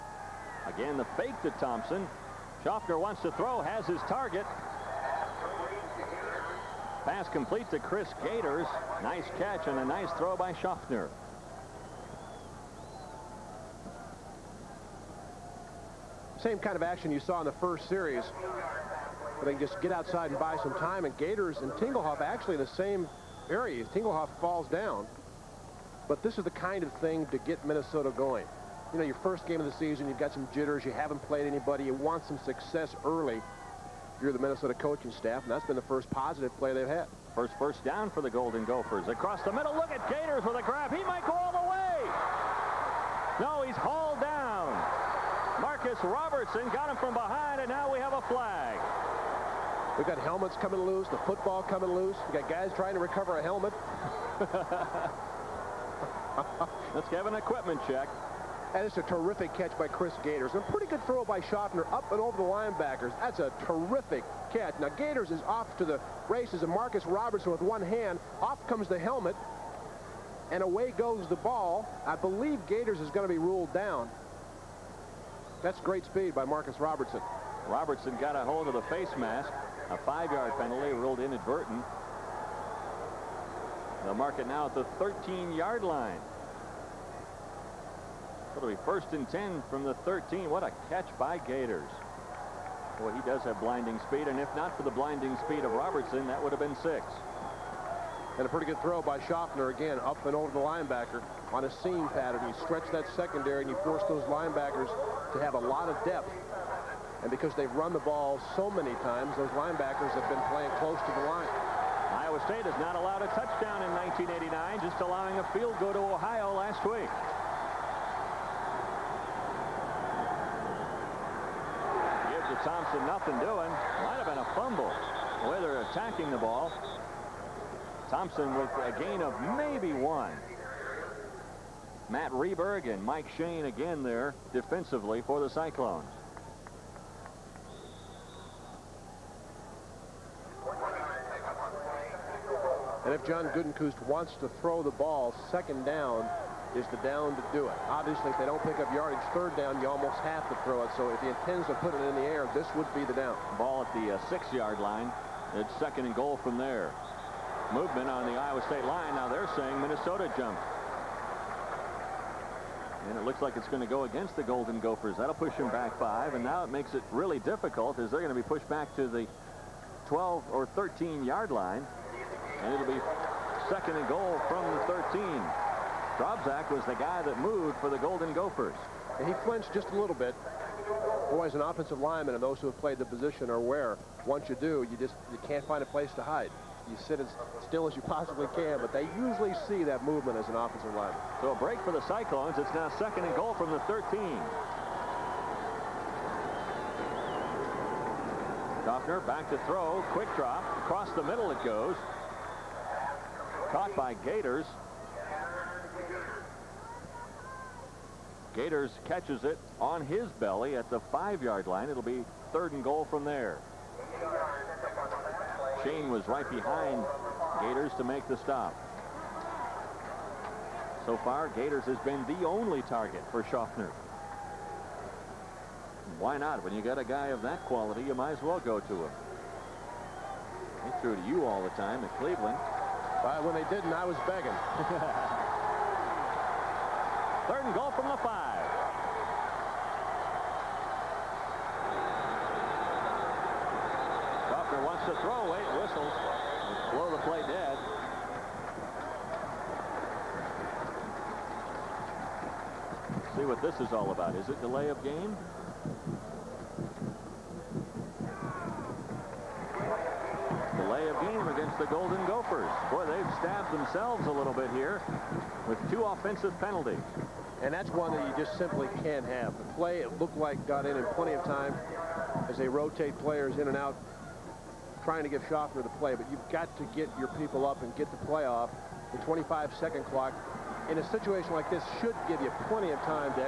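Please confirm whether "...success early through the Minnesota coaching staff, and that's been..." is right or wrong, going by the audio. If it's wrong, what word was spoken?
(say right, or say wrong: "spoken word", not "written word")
right.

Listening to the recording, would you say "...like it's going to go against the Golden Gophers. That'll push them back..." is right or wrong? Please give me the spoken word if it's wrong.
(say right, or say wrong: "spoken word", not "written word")
right.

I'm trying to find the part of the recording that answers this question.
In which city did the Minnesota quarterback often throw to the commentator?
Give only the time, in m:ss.
3:52.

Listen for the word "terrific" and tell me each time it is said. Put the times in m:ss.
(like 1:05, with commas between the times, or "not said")
0:59, 1:03.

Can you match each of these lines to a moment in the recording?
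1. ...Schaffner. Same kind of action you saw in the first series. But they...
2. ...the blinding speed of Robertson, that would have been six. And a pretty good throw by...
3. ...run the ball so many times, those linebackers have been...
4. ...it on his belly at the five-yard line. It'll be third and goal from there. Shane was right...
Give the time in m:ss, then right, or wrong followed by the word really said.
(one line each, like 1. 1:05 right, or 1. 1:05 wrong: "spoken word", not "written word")
1. 0:10 right
2. 1:34 right
3. 1:47 right
4. 3:29 right.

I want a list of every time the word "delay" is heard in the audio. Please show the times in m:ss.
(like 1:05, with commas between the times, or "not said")
4:14, 4:20.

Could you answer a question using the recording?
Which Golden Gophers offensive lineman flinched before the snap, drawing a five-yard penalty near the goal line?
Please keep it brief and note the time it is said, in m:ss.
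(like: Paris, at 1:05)
Drobzak, at 2:56.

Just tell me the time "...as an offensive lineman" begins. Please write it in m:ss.
3:10.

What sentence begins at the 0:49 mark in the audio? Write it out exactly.
We've got helmets coming loose, the football coming loose.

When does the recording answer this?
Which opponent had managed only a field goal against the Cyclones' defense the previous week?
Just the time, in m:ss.
1:55.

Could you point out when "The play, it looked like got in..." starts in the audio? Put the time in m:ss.
4:29.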